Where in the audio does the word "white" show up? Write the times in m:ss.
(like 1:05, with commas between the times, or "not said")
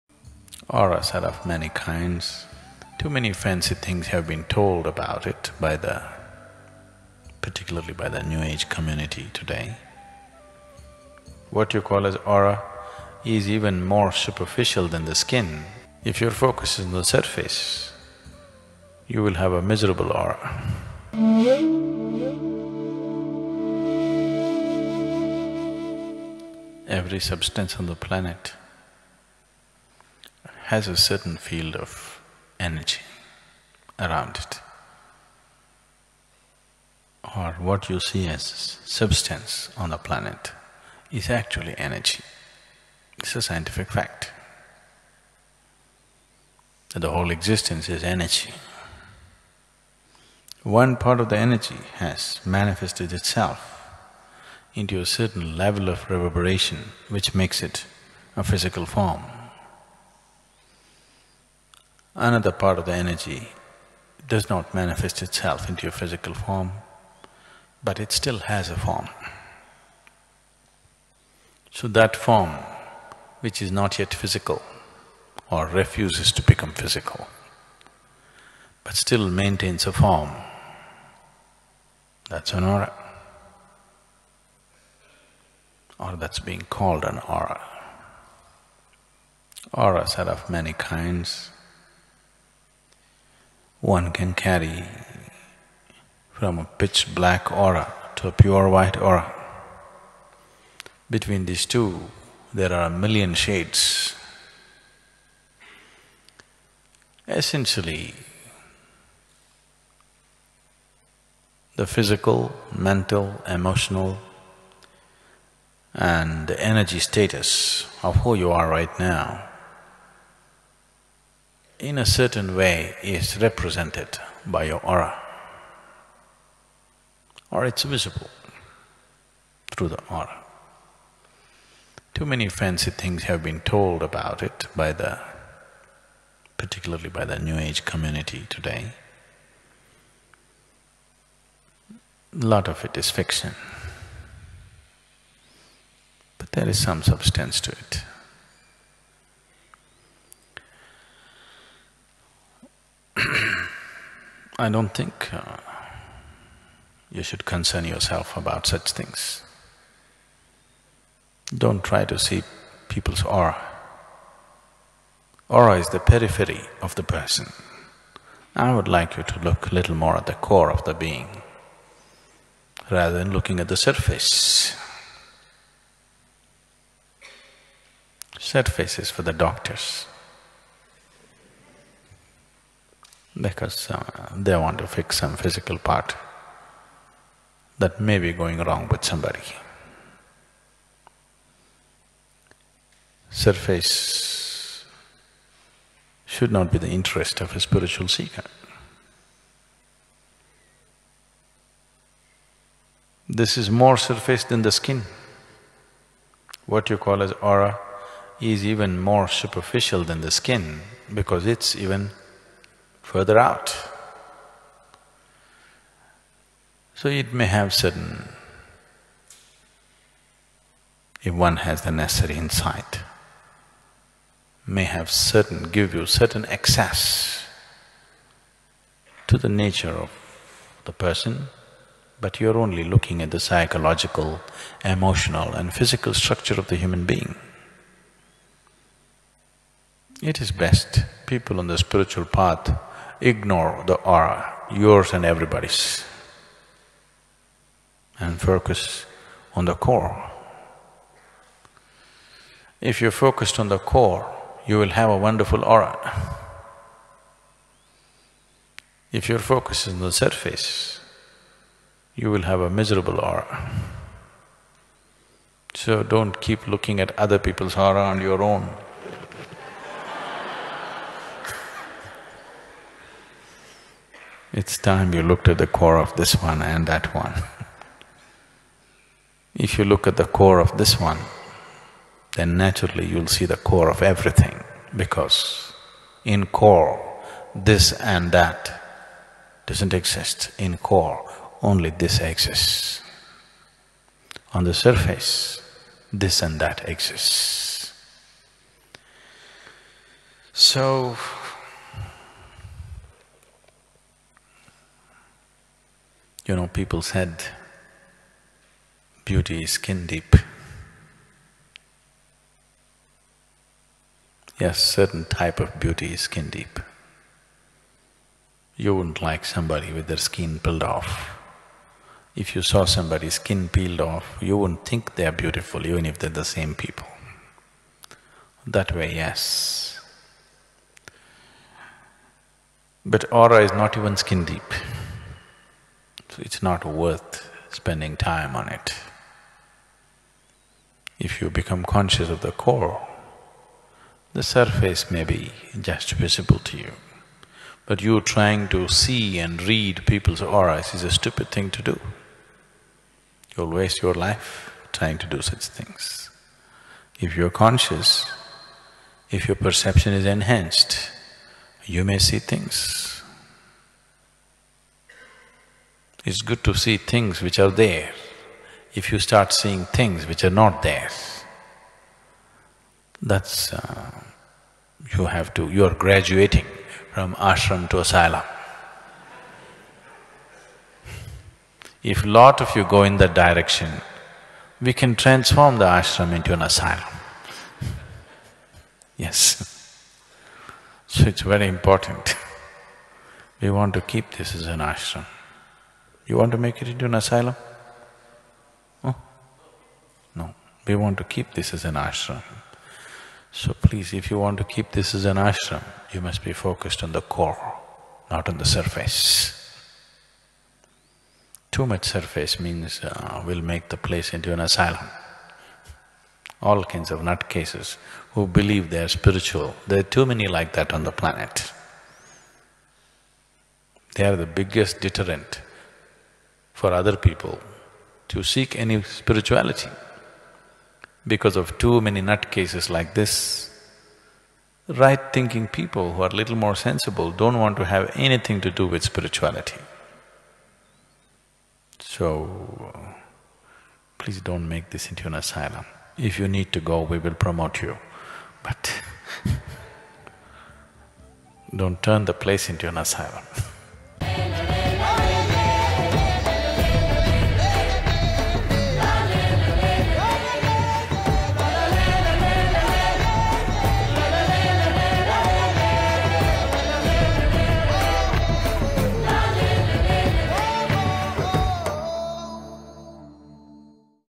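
1:38.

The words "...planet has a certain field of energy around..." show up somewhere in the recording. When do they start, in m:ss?
0:27.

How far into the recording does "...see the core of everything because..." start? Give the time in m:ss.
4:43.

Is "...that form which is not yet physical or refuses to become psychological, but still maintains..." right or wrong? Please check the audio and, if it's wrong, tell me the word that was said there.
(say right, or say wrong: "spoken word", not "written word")
wrong: "physical", not "psychological".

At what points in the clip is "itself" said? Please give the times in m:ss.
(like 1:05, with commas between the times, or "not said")
0:53, 1:05.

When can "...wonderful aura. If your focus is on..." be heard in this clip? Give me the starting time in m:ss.
4:15.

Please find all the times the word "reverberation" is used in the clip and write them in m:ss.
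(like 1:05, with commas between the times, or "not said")
0:56.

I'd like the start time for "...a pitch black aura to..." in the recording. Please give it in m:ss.
1:36.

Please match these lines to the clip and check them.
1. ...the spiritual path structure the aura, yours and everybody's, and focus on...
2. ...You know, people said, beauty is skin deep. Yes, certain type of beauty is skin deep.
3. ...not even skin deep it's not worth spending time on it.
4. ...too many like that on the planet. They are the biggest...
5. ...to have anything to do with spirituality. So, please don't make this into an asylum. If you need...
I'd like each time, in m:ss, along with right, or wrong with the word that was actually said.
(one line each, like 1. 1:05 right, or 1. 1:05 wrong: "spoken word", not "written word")
1. 4:01 wrong: "ignore", not "structure"
2. 5:06 right
3. 5:33 right
4. 7:00 right
5. 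7:17 right.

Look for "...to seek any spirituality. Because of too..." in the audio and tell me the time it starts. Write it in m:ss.
7:08.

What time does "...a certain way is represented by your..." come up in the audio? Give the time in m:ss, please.
2:01.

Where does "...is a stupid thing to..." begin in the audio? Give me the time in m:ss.
5:50.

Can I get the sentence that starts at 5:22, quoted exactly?
If you saw somebody's skin peeled off, you wouldn't think they're beautiful even if they're the same people.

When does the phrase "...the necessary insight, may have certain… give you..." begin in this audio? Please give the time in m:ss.
3:41.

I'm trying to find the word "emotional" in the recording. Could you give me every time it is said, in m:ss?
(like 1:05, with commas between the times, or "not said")
1:53, 3:54.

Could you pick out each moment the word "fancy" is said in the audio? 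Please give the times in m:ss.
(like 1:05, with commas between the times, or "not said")
0:03, 2:12.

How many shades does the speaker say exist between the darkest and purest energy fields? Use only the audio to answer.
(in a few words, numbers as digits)
a million.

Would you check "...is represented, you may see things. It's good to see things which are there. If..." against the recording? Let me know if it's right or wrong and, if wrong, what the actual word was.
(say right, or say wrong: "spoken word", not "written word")
wrong: "enhanced", not "represented".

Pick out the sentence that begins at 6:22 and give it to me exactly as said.
If lot of you go in that direction, we can transform the ashram into an asylum.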